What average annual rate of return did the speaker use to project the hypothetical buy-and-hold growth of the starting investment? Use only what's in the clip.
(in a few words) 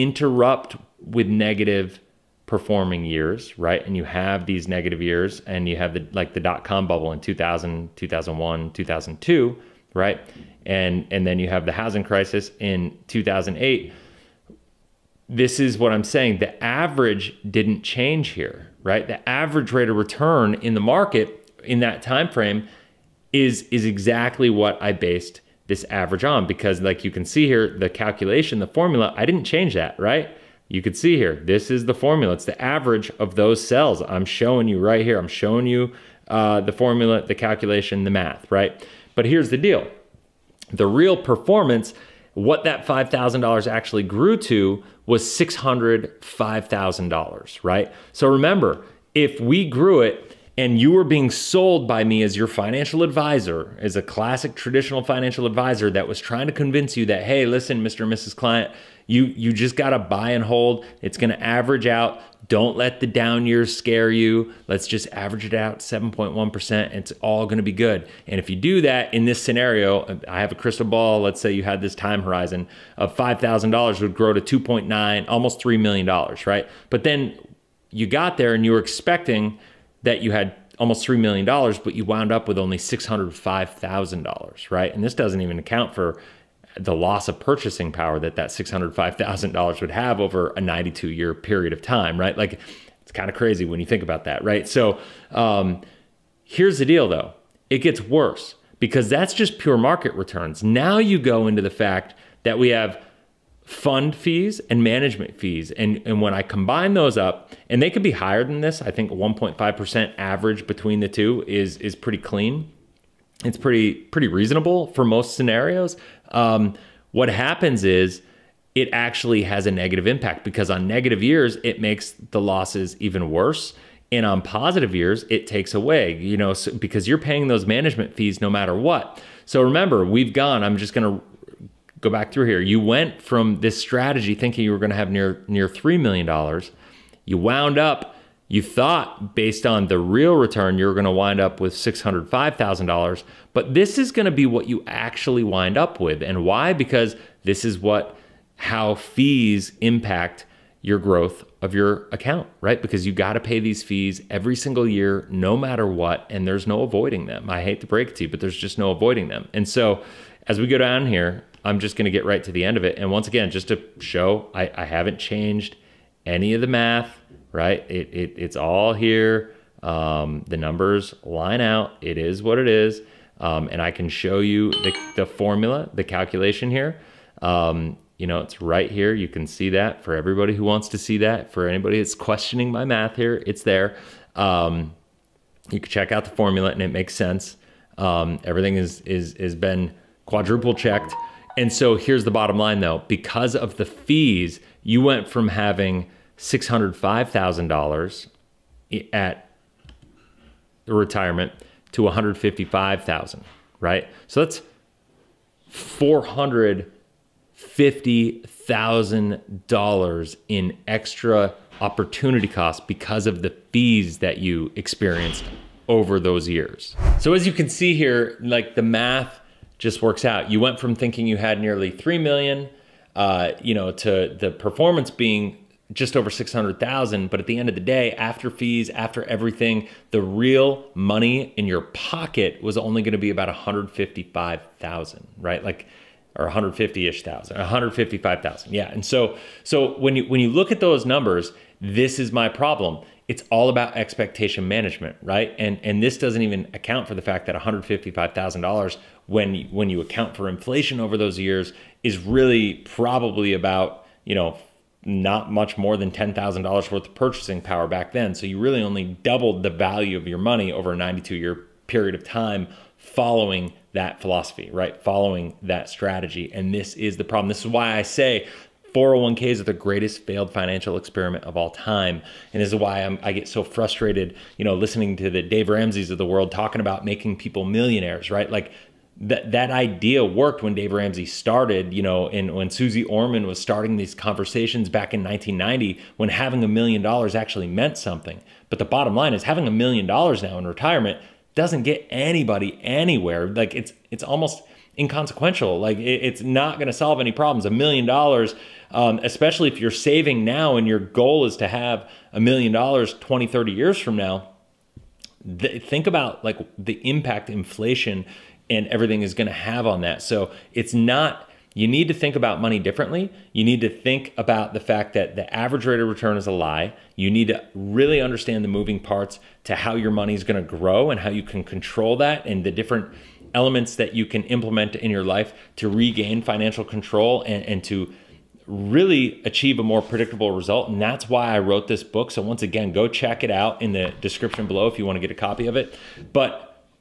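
7.1%.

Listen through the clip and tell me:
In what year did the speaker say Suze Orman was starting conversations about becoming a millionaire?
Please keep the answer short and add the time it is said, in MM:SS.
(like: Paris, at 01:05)
1990, at 04:45.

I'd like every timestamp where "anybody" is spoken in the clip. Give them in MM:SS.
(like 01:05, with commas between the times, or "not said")
03:01, 04:52.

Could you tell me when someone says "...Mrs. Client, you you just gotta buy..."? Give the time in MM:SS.
00:58.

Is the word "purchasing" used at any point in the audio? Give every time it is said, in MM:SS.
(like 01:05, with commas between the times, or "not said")
01:27, 04:17.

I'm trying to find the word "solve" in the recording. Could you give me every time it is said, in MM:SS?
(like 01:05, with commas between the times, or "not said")
04:56.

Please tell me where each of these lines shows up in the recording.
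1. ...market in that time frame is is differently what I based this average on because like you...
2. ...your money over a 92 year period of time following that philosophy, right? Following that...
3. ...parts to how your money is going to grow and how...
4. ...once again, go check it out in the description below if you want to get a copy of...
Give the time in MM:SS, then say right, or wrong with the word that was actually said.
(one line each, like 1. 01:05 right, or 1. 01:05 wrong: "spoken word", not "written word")
1. 00:20 wrong: "exactly", not "differently"
2. 04:20 right
3. 05:18 right
4. 05:32 right.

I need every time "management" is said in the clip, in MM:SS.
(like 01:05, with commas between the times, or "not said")
01:44, 02:07, 04:04.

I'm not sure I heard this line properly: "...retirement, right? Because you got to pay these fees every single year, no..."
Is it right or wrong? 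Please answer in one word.
wrong.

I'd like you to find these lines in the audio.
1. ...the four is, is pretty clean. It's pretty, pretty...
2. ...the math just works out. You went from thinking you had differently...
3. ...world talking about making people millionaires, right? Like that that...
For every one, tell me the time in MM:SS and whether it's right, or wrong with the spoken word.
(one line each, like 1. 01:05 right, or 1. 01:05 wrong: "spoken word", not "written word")
1. 01:50 wrong: "two", not "four"
2. 03:38 wrong: "nearly", not "differently"
3. 04:36 right.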